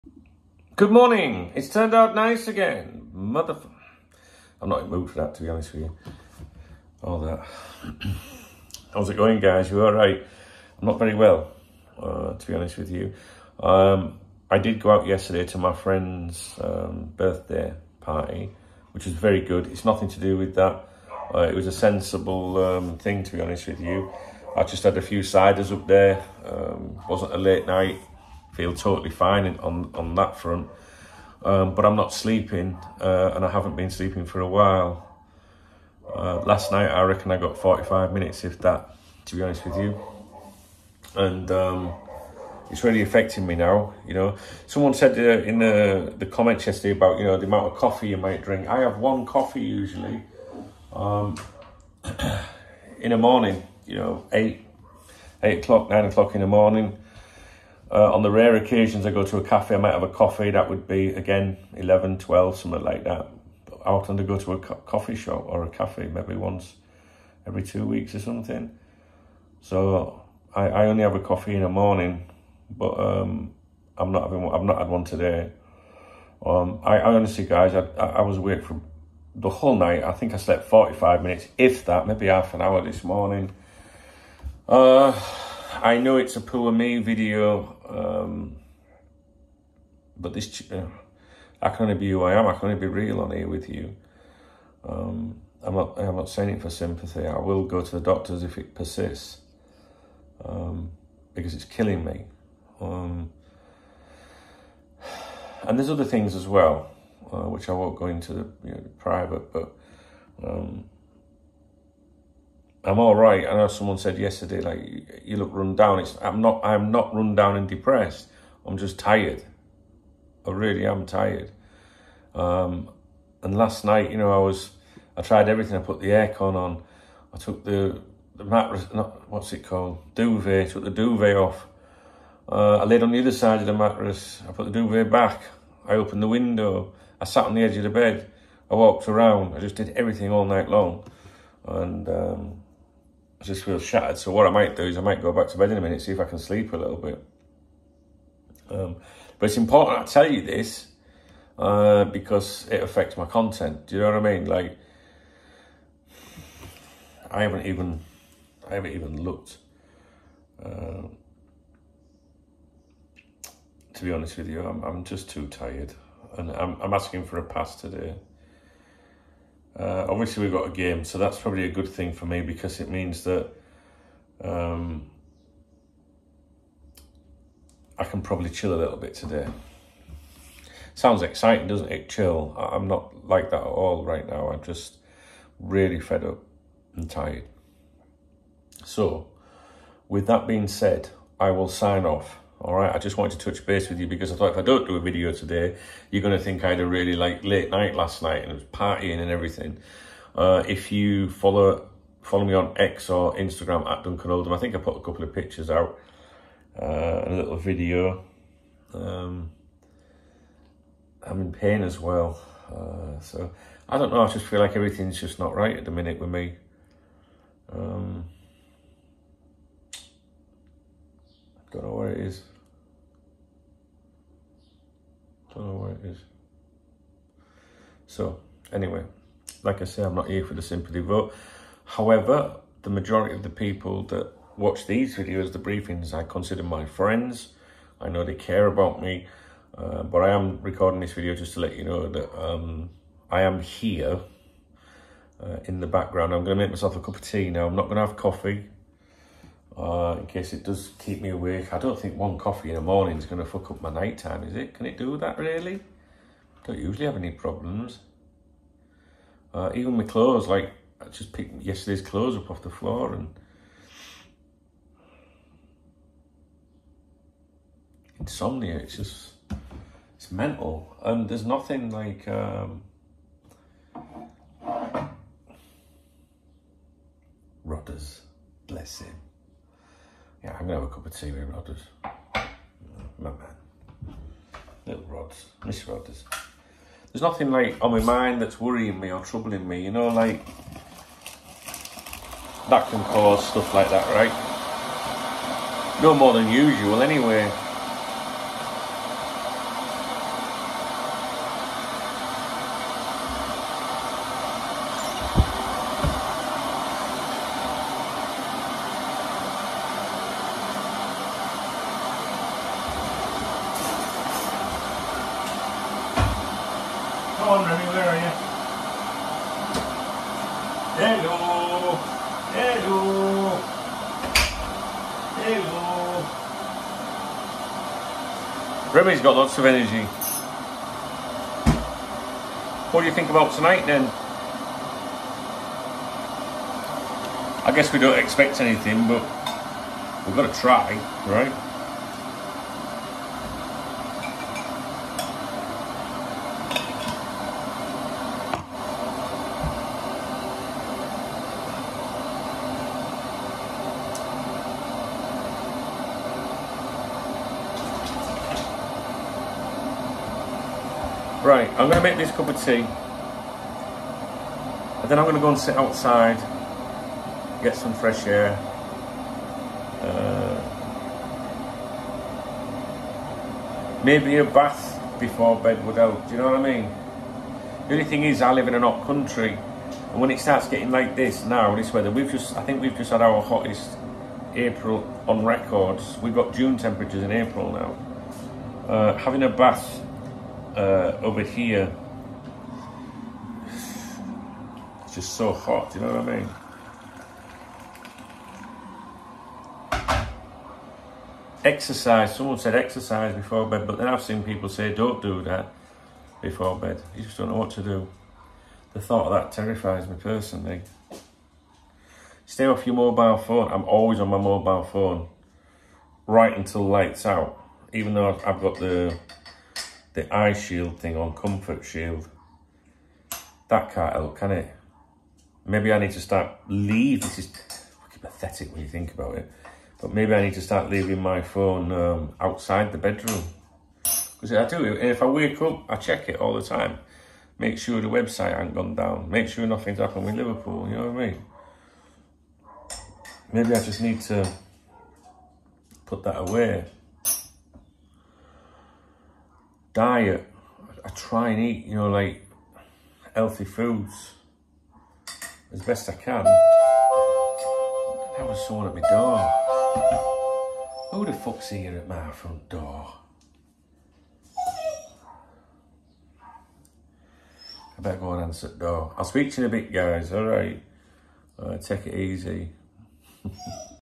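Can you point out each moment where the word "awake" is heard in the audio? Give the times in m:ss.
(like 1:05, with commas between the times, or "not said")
1:18, 4:11.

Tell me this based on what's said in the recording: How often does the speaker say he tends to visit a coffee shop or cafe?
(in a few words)
once every two weeks.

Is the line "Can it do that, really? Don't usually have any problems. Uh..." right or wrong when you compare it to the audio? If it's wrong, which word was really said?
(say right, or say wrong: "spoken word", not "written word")
right.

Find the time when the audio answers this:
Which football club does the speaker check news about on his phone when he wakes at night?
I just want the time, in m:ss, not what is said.
7:20.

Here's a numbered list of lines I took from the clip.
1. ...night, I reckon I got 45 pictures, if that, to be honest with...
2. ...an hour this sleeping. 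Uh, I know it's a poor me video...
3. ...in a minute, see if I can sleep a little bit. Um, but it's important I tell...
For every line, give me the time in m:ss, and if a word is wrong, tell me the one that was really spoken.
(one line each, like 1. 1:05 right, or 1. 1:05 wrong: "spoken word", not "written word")
1. 0:36 wrong: "minutes", not "pictures"
2. 1:22 wrong: "morning", not "sleeping"
3. 2:25 right.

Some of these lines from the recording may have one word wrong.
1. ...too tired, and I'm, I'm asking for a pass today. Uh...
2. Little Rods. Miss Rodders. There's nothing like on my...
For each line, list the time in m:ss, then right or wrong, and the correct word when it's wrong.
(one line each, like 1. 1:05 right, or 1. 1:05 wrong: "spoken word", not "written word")
1. 2:45 right
2. 4:44 right.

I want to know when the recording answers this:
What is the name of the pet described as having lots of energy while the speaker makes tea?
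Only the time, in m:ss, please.
5:28.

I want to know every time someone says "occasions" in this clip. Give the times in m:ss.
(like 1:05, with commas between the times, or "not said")
0:58.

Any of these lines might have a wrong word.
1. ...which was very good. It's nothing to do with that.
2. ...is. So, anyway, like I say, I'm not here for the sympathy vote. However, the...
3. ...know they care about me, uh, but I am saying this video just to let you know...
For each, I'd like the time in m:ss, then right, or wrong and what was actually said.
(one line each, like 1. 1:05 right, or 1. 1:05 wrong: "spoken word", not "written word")
1. 0:18 right
2. 3:46 right
3. 3:58 wrong: "recording", not "saying".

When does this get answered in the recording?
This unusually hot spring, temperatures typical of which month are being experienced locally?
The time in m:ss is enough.
6:26.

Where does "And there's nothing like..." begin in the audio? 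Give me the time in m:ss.
4:31.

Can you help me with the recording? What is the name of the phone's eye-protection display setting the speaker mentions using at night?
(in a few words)
comfort shield.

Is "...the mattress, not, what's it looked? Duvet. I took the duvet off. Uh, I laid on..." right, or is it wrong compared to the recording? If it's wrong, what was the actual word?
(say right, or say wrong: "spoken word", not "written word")
wrong: "called", not "looked".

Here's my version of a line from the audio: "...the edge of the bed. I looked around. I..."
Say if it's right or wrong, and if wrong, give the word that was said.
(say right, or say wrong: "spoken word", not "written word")
wrong: "walked", not "looked".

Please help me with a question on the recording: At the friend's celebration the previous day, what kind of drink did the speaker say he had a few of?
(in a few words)
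ciders.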